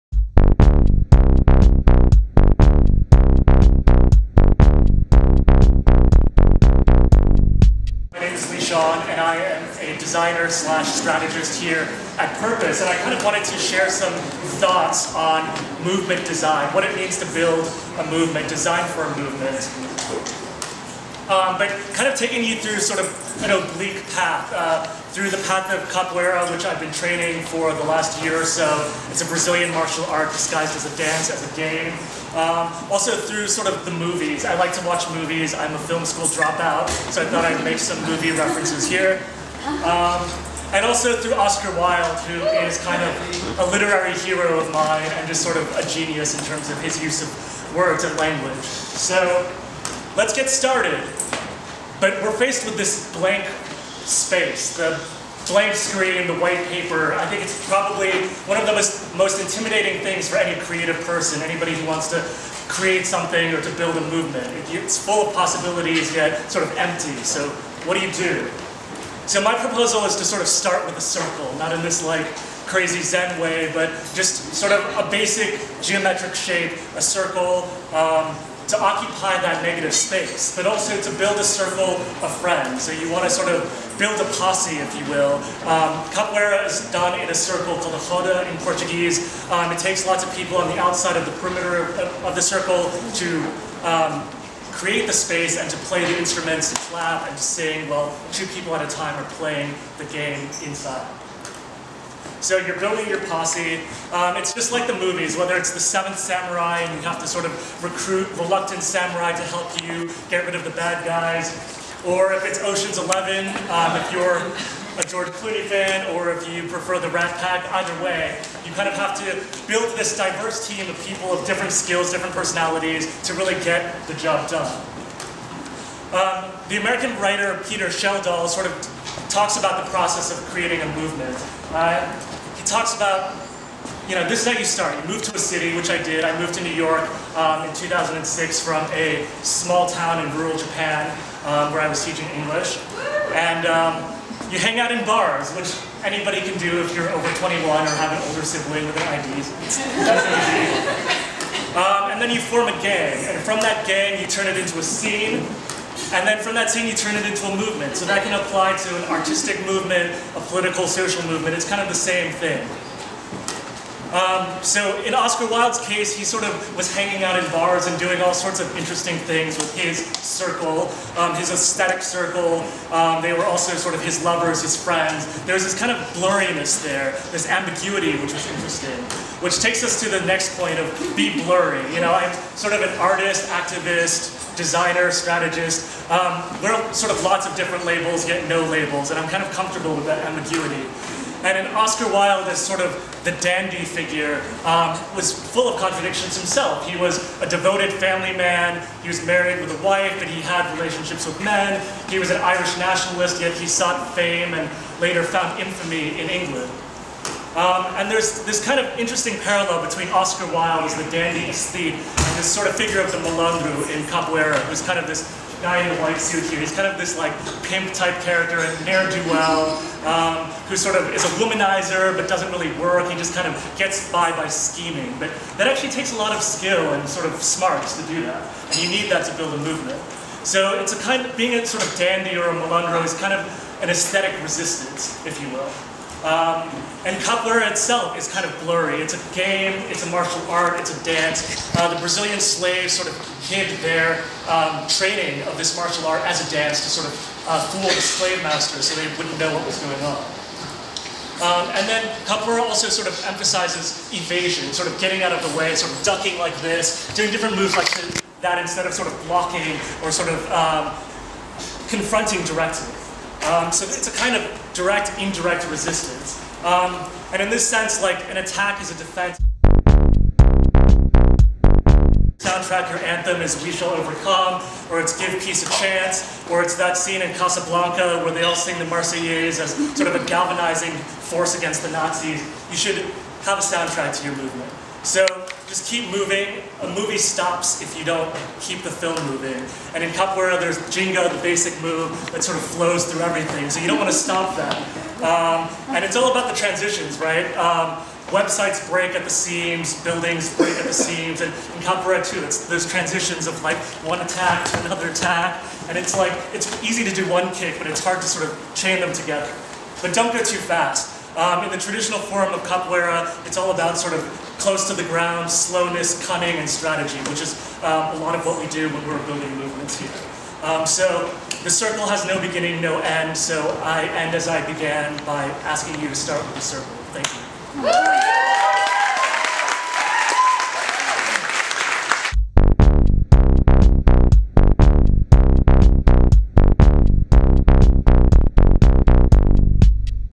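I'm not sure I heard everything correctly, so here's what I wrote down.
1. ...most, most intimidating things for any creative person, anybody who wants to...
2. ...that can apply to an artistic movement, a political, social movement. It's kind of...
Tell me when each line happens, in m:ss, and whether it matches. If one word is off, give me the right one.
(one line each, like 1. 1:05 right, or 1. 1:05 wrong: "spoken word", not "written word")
1. 0:58 right
2. 2:38 right.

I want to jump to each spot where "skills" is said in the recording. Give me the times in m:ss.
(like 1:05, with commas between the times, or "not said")
2:01, 3:46.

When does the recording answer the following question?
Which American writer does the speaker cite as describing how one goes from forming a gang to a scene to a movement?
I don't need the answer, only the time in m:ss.
2:07.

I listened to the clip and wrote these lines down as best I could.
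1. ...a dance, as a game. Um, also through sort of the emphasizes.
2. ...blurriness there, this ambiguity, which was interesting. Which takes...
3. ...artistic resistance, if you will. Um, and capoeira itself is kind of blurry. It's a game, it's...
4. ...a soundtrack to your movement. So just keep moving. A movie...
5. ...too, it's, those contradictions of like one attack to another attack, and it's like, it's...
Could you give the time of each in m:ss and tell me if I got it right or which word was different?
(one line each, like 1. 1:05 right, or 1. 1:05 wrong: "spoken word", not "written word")
1. 0:30 wrong: "movies", not "emphasizes"
2. 2:56 right
3. 3:53 wrong: "aesthetic", not "artistic"
4. 4:43 right
5. 5:02 wrong: "transitions", not "contradictions".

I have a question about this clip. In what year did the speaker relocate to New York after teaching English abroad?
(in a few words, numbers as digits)
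2006.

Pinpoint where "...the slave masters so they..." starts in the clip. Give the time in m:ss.
4:07.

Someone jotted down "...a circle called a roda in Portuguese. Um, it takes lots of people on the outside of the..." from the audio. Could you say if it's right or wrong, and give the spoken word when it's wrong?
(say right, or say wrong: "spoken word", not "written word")
right.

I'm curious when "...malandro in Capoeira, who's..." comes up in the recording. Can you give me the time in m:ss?
3:33.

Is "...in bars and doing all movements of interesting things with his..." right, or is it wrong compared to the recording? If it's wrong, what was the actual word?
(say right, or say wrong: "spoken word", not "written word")
wrong: "sorts", not "movements".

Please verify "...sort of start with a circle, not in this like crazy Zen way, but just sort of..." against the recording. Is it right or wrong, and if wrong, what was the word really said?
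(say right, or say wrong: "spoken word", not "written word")
right.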